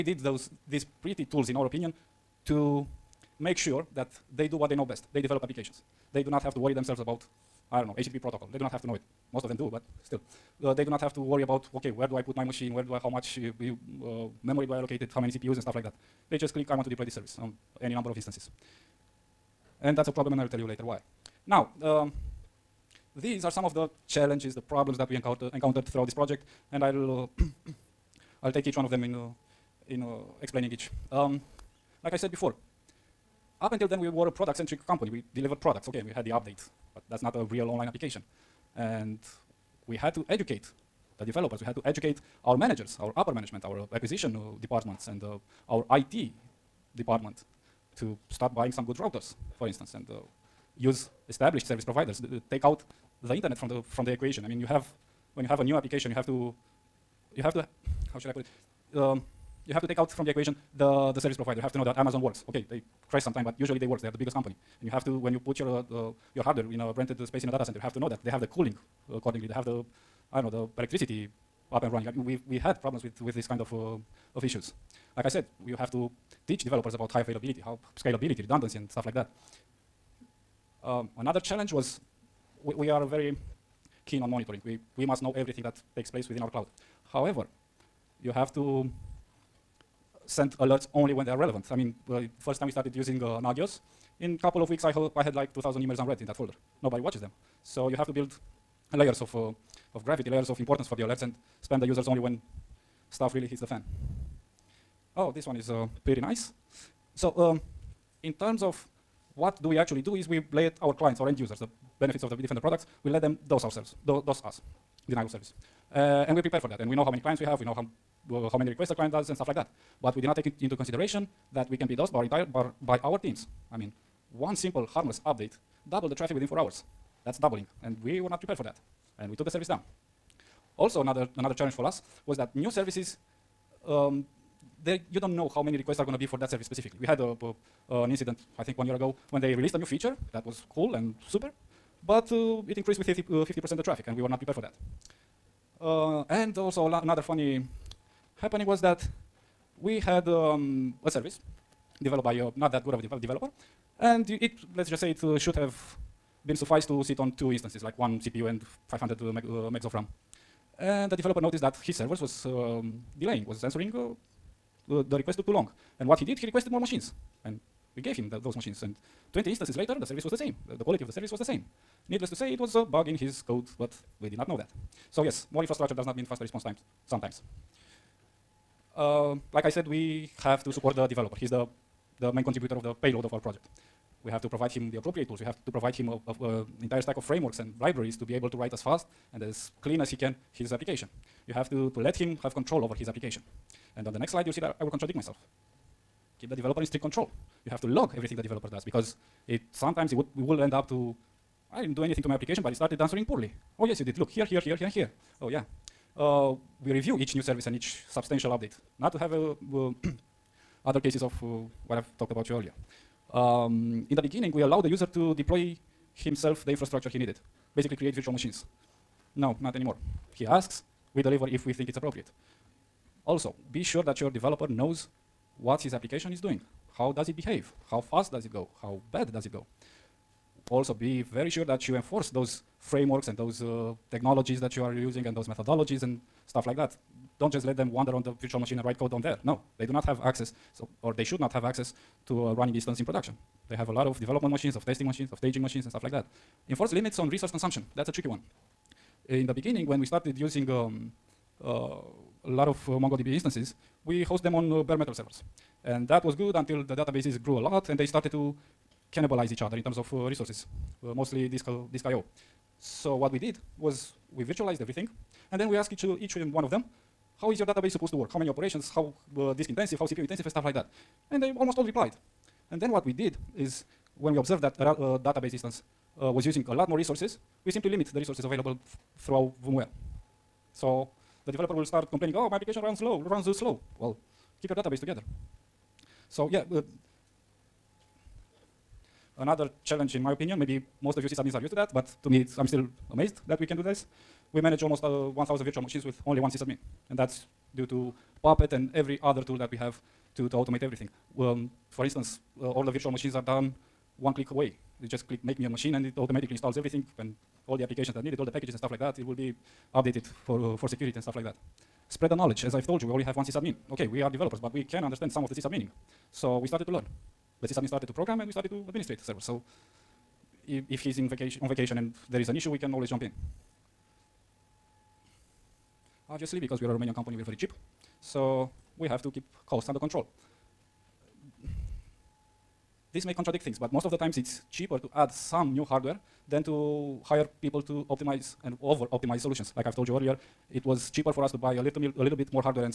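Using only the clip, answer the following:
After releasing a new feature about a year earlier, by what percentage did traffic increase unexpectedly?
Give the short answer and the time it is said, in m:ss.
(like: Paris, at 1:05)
50%, at 2:23.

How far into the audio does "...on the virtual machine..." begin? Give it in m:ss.
3:58.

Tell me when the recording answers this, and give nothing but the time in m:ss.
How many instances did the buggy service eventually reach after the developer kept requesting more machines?
2:49.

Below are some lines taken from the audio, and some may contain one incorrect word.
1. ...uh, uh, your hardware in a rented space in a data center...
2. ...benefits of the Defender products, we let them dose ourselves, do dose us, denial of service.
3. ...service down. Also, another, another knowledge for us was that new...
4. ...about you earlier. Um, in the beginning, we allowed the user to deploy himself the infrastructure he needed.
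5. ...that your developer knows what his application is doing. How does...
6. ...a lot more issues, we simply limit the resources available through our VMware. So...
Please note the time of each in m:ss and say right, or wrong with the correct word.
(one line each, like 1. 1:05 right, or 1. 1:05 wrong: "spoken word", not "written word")
1. 1:05 right
2. 1:51 right
3. 2:09 wrong: "challenge", not "knowledge"
4. 3:32 right
5. 3:44 right
6. 4:36 wrong: "resources", not "issues".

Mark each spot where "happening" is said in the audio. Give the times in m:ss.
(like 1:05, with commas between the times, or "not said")
2:28.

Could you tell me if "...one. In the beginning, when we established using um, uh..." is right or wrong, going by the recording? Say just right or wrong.
wrong.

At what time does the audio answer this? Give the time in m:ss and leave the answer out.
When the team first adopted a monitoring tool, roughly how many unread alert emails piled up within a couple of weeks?
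1:35.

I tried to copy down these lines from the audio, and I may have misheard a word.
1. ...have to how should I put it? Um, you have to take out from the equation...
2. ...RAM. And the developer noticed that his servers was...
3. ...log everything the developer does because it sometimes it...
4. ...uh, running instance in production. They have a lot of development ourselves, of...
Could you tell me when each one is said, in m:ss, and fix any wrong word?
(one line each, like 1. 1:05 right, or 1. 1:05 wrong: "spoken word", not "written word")
1. 0:57 right
2. 2:39 right
3. 3:17 right
4. 4:02 wrong: "machines", not "ourselves".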